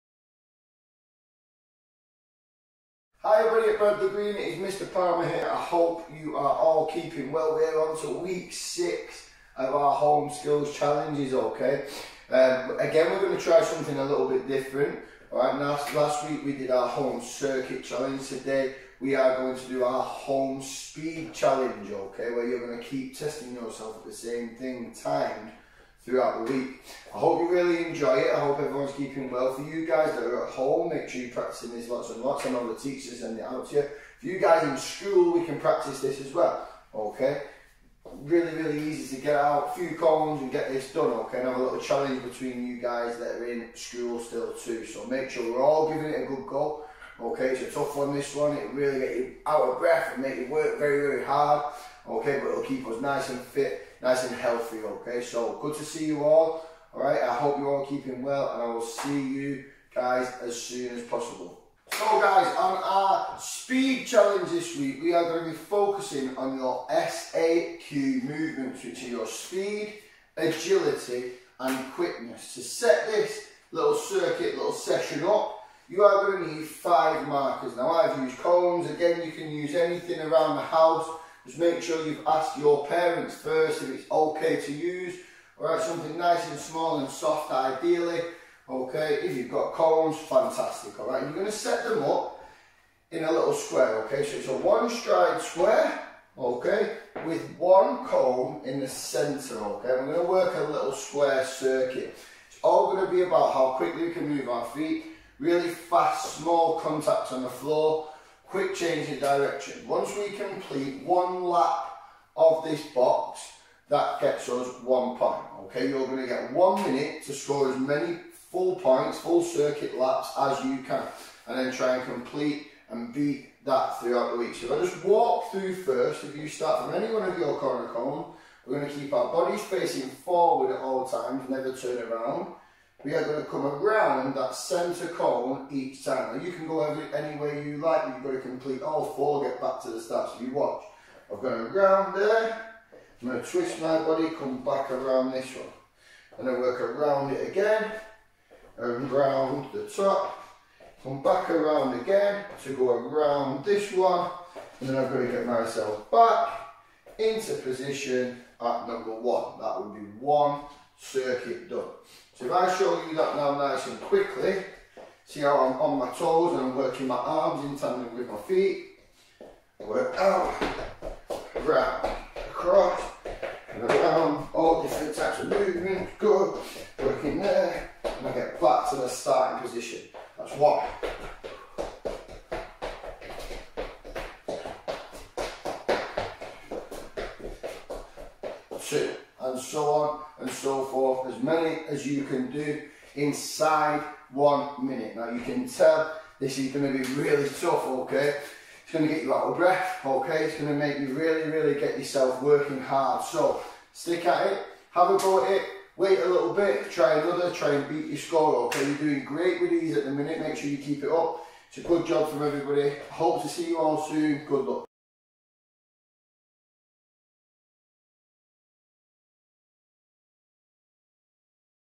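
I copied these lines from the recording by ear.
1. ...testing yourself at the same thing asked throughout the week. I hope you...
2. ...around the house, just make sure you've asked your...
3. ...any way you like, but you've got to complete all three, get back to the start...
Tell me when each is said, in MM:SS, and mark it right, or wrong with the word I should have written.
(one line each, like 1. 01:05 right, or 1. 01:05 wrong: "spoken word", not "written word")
1. 00:23 wrong: "timed", not "asked"
2. 01:20 right
3. 02:17 wrong: "four", not "three".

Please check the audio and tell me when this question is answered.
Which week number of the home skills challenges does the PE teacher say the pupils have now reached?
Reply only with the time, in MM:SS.
00:08.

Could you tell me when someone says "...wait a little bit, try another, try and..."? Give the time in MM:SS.
03:25.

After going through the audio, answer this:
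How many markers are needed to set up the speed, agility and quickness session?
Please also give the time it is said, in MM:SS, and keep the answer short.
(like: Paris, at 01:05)
5, at 01:16.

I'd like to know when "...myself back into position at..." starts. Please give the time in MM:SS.
02:35.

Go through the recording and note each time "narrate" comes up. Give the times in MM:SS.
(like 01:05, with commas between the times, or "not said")
not said.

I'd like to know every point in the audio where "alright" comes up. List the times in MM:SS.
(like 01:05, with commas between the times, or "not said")
00:15, 01:25, 01:30.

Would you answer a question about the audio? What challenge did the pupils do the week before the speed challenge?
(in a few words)
home circuit challenge.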